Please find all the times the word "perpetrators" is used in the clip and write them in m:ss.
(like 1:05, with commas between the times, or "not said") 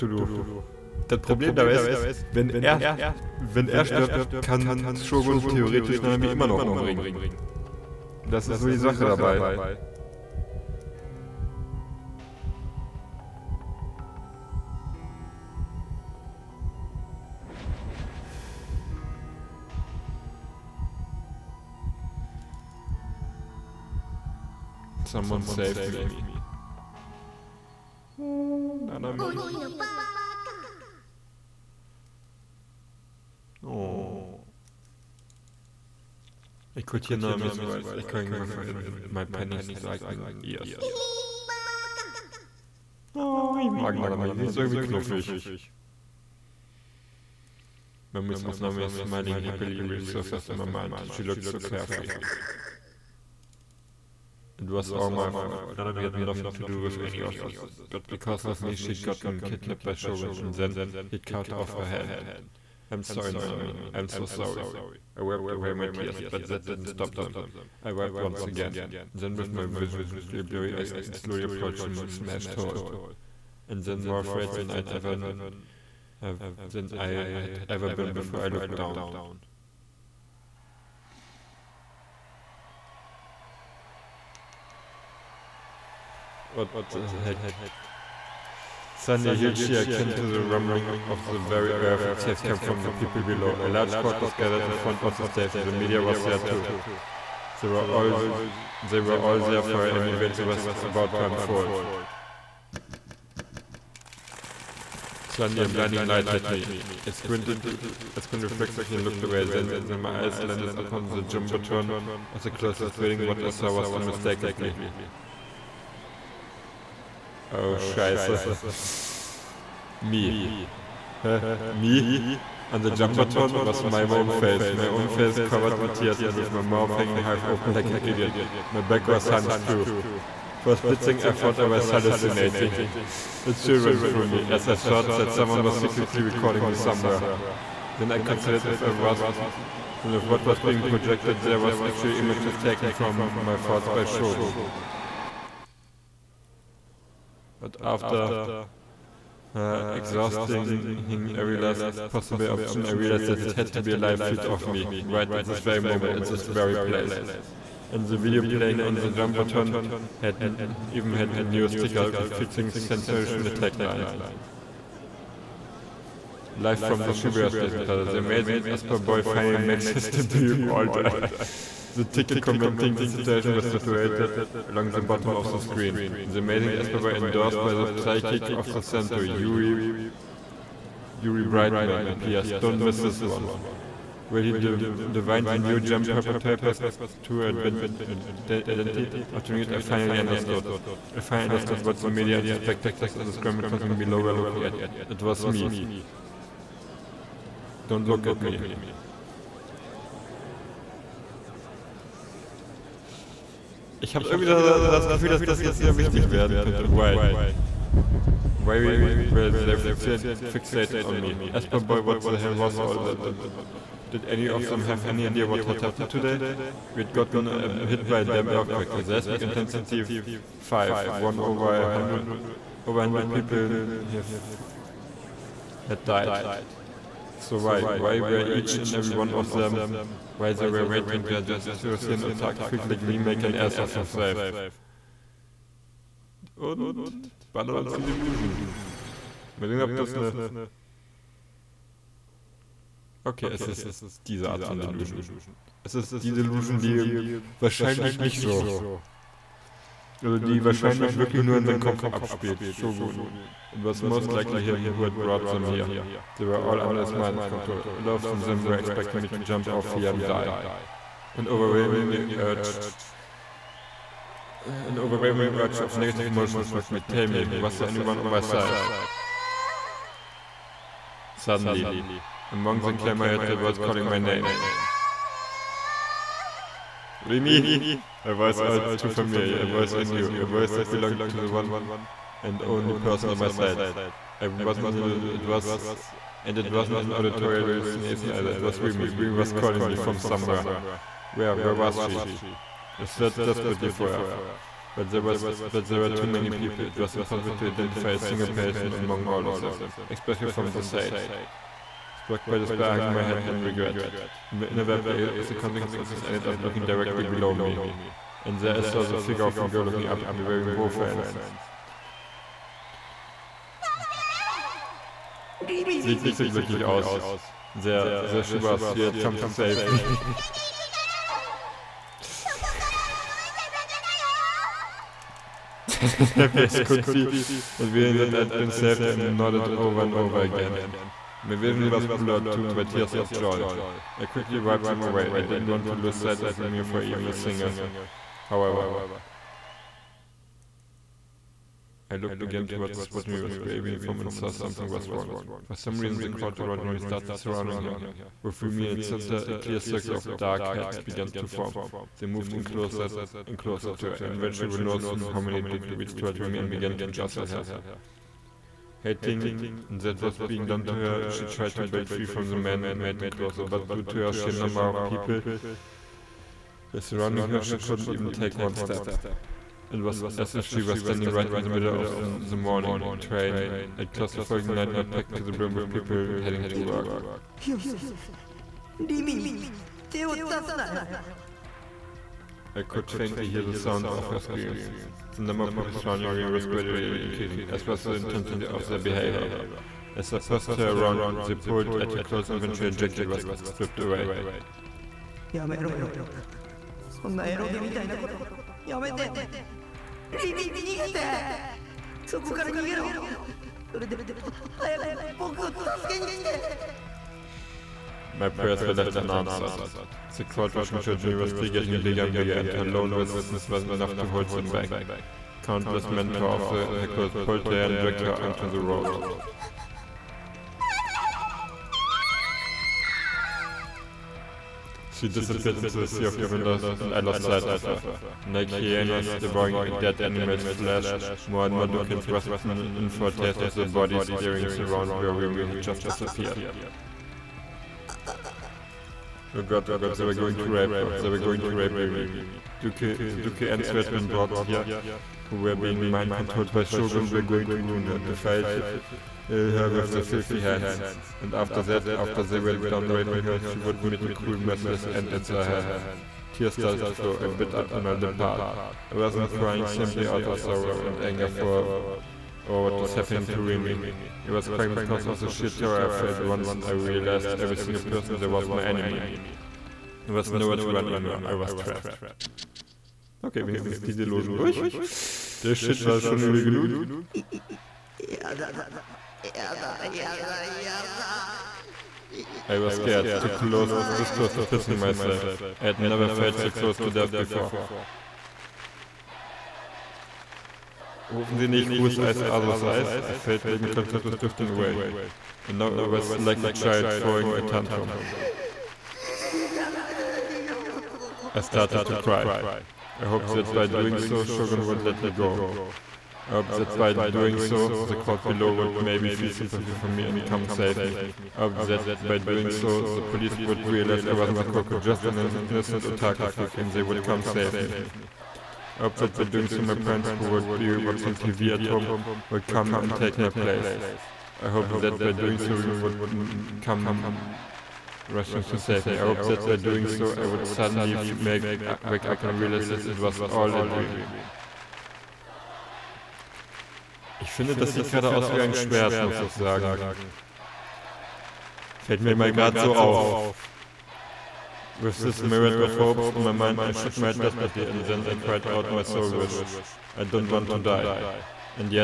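3:06.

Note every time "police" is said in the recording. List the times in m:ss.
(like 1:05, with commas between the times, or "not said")
8:33.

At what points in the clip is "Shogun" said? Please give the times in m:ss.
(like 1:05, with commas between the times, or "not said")
0:04, 0:59, 2:24, 4:12, 7:26, 8:24.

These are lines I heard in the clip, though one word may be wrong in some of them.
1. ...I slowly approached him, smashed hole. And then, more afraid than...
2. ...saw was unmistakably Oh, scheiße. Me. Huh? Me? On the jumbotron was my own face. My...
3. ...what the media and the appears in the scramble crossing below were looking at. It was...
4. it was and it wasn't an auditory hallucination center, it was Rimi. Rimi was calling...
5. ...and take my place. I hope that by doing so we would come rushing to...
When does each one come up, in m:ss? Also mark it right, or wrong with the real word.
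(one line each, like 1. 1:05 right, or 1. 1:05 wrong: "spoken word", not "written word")
1. 1:10 right
2. 1:53 right
3. 3:11 wrong: "spectators", not "appears"
4. 4:45 wrong: "either", not "center"
5. 8:42 right.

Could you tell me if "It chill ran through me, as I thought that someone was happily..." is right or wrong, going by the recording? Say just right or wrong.
wrong.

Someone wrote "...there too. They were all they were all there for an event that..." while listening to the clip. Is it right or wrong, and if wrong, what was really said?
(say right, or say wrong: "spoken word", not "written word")
right.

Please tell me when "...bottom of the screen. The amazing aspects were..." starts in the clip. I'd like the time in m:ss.
2:55.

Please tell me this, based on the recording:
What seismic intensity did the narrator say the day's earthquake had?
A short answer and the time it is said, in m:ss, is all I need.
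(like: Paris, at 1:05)
5, at 3:39.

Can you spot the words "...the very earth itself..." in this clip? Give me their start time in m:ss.
1:31.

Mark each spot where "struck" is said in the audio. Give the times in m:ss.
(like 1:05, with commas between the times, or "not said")
4:26, 5:02.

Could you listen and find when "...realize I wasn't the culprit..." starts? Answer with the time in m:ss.
8:33.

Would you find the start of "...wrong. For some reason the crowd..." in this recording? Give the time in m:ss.
5:45.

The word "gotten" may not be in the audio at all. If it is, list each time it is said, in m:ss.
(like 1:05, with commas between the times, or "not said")
0:59, 3:37.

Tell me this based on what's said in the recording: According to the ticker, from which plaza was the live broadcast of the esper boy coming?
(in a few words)
Shibuya Station Plaza.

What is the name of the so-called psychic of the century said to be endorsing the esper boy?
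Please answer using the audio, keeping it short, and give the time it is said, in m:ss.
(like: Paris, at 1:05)
Yuri Brightman, at 3:01.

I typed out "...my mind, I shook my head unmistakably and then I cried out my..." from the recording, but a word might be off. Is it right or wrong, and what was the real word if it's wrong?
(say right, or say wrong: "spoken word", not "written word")
wrong: "desperately", not "unmistakably".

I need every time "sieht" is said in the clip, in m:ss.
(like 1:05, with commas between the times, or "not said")
5:16, 8:57.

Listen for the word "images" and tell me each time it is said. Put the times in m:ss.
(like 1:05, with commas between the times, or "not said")
2:22.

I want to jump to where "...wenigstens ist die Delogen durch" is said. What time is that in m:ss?
7:53.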